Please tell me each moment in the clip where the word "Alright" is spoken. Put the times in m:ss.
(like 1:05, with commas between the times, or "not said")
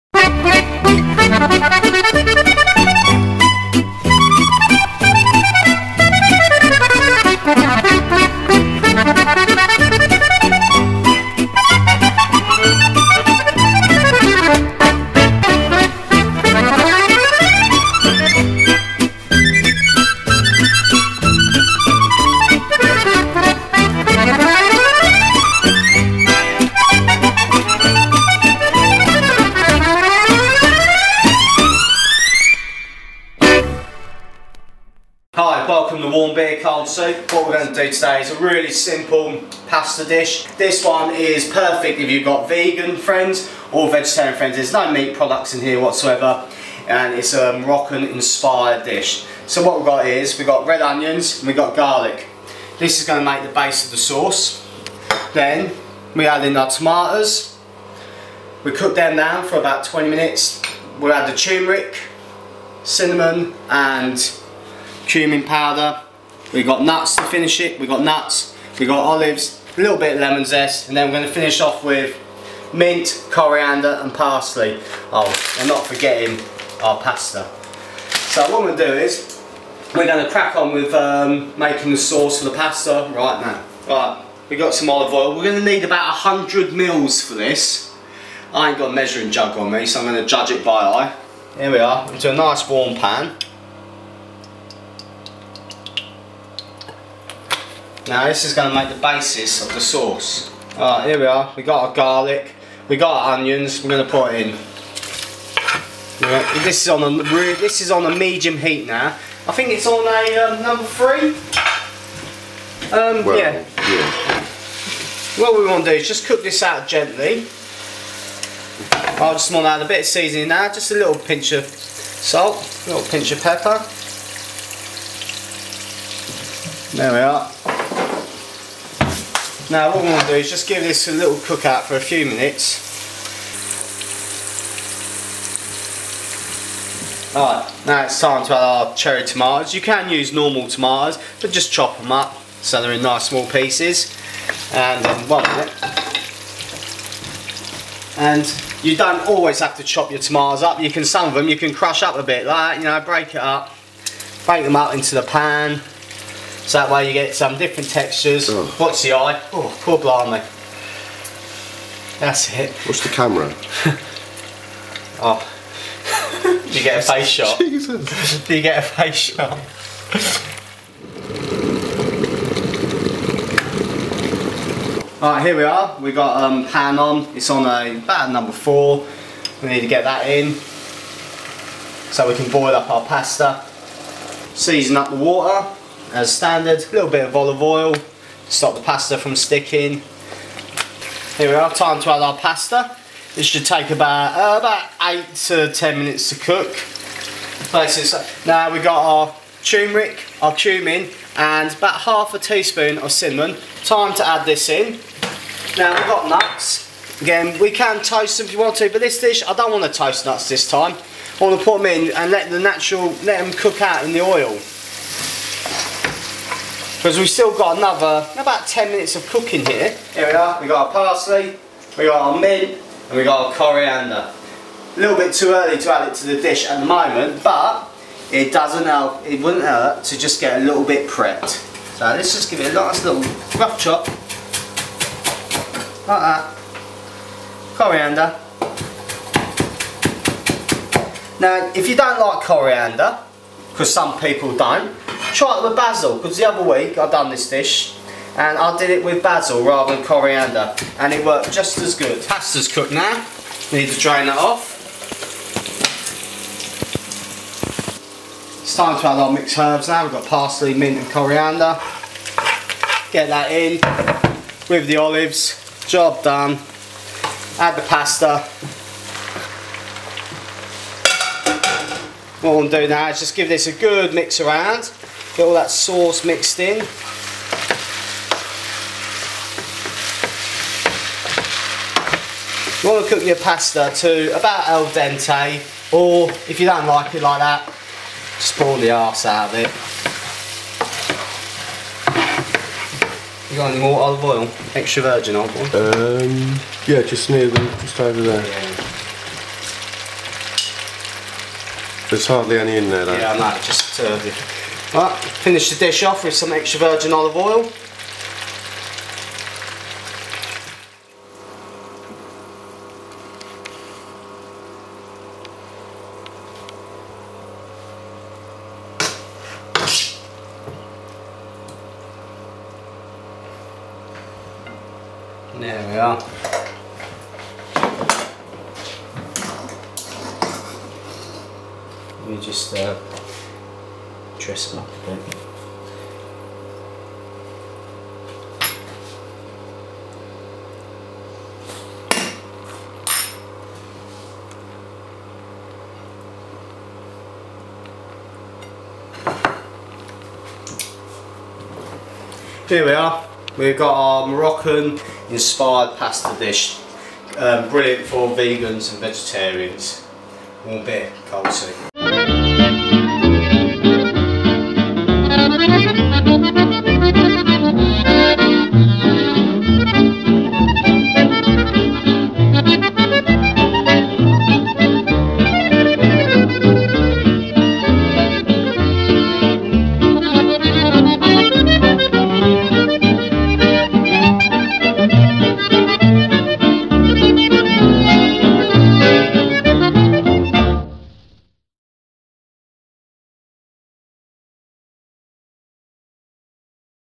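1:40, 2:17, 2:55.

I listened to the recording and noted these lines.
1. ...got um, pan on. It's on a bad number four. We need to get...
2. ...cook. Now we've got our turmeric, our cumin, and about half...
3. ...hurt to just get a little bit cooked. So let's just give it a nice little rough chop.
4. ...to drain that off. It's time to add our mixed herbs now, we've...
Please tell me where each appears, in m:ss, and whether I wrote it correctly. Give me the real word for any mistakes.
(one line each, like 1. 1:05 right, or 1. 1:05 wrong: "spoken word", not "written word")
1. 2:56 right
2. 3:16 right
3. 3:49 wrong: "prepped", not "cooked"
4. 4:13 right.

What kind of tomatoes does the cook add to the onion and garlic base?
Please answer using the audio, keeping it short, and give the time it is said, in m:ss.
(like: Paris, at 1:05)
Cherry tomatoes, at 2:18.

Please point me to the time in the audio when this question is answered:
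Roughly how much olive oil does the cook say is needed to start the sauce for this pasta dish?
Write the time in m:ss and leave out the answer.
1:25.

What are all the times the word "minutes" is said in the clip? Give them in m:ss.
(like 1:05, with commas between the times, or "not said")
1:00, 2:12, 2:25, 3:15, 3:38.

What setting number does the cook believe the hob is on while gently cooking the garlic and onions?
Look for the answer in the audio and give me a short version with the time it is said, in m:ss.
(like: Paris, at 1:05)
3, at 1:50.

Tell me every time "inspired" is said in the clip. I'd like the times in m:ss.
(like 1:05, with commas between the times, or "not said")
0:48, 5:55.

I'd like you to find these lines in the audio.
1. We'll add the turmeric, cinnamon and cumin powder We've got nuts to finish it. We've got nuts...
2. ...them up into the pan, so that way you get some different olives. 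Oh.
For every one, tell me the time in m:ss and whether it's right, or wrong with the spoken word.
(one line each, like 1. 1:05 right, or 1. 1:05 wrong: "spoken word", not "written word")
1. 1:00 right
2. 2:34 wrong: "textures", not "olives".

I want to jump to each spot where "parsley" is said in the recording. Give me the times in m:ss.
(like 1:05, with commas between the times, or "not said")
1:14, 3:40, 4:20.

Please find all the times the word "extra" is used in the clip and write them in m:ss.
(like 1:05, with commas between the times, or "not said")
4:54, 5:06.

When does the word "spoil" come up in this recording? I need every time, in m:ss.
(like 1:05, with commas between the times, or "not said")
4:48.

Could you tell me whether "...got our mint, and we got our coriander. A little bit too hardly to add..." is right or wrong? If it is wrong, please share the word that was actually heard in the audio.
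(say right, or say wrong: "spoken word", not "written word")
wrong: "early", not "hardly".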